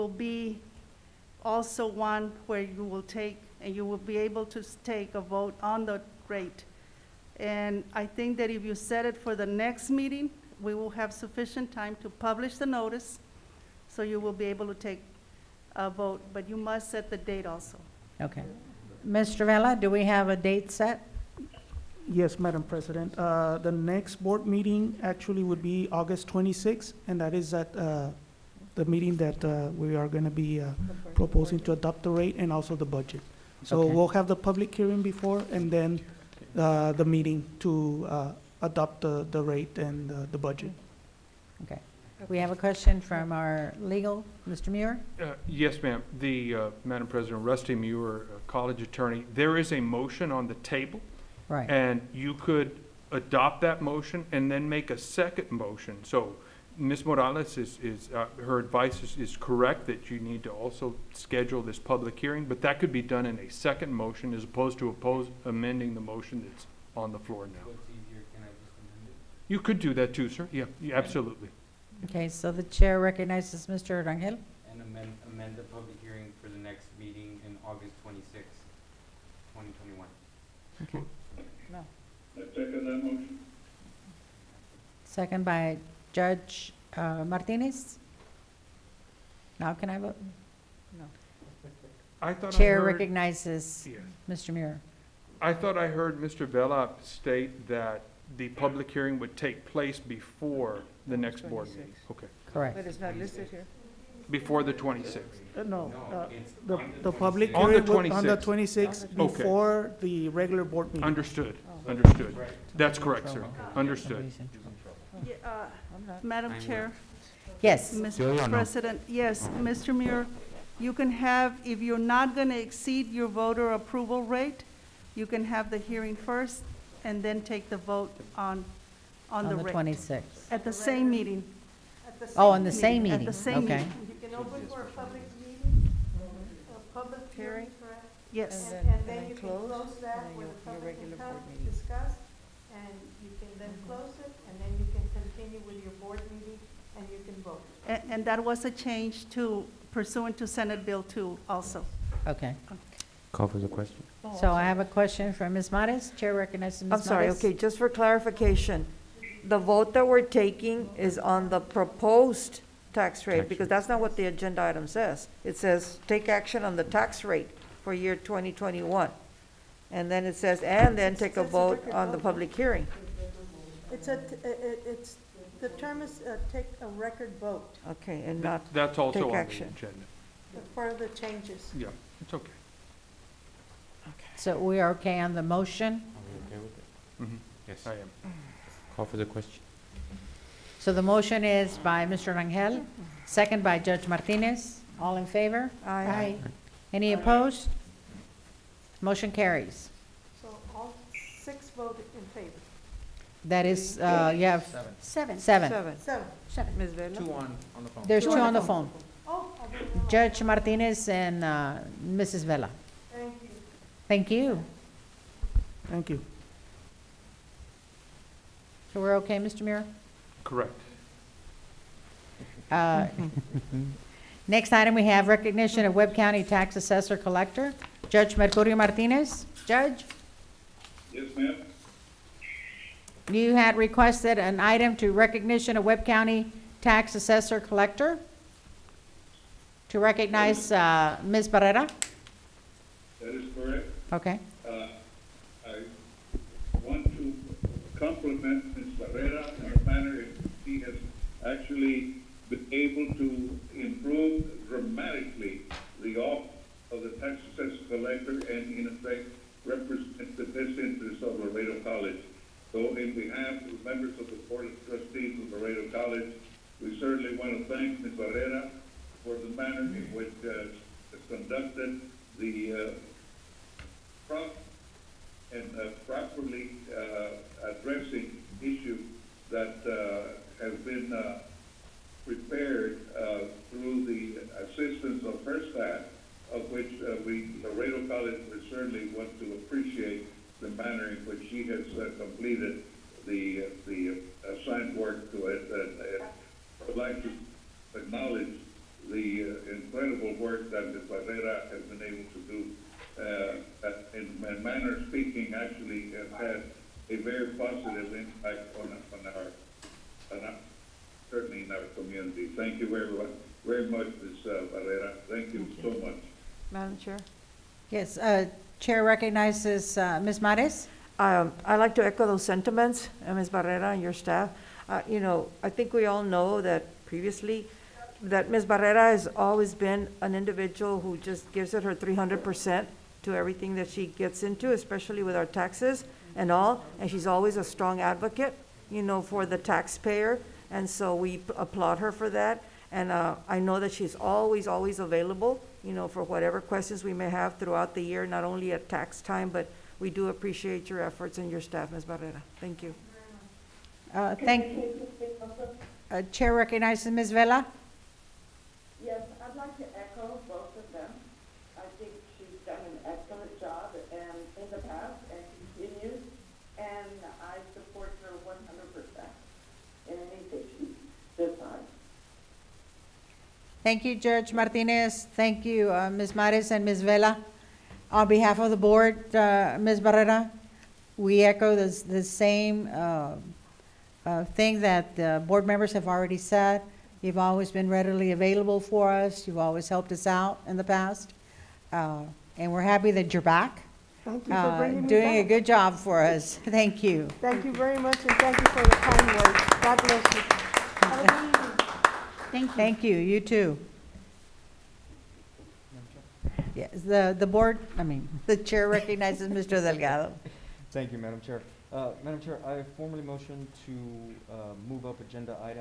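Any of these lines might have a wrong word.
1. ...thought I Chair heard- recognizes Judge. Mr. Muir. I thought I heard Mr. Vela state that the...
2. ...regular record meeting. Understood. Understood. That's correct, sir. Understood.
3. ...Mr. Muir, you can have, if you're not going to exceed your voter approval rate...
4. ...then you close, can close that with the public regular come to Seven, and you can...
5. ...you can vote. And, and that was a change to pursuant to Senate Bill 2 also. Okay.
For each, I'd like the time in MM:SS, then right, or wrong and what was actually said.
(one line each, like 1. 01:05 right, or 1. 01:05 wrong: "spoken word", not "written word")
1. 01:32 wrong: "Yes", not "Judge"
2. 01:50 wrong: "board", not "record"
3. 01:59 right
4. 02:19 wrong: "Discuss", not "Seven"
5. 02:27 right.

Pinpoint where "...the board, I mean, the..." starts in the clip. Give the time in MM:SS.
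06:47.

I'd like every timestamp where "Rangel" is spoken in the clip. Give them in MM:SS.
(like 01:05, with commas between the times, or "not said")
01:14, 03:12.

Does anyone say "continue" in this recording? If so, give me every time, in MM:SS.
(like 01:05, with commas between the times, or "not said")
02:25.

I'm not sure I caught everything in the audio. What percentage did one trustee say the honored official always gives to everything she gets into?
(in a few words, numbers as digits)
300%.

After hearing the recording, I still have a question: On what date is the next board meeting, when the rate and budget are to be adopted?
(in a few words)
August 26th.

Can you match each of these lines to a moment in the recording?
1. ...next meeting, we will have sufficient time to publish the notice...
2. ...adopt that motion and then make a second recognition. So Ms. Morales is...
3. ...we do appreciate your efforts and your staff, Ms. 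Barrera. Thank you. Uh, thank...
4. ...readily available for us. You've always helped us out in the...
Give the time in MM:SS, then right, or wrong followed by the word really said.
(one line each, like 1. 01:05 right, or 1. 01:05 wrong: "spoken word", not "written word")
1. 00:09 right
2. 00:53 wrong: "motion", not "recognition"
3. 05:49 right
4. 06:27 right.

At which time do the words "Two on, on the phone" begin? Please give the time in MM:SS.
03:27.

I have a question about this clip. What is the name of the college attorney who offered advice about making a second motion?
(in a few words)
Rusty Muir.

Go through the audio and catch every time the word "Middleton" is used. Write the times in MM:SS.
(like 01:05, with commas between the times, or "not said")
not said.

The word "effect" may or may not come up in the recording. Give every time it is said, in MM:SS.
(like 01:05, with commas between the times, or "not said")
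04:18.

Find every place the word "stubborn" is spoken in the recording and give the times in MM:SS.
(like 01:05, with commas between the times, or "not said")
not said.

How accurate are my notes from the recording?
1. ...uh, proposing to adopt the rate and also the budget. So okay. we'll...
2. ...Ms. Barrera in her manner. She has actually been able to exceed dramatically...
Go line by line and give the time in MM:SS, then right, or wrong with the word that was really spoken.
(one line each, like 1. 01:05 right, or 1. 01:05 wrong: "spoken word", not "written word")
1. 00:30 right
2. 04:08 wrong: "improved", not "exceed".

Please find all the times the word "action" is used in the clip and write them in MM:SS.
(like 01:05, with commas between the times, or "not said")
02:46, 02:59.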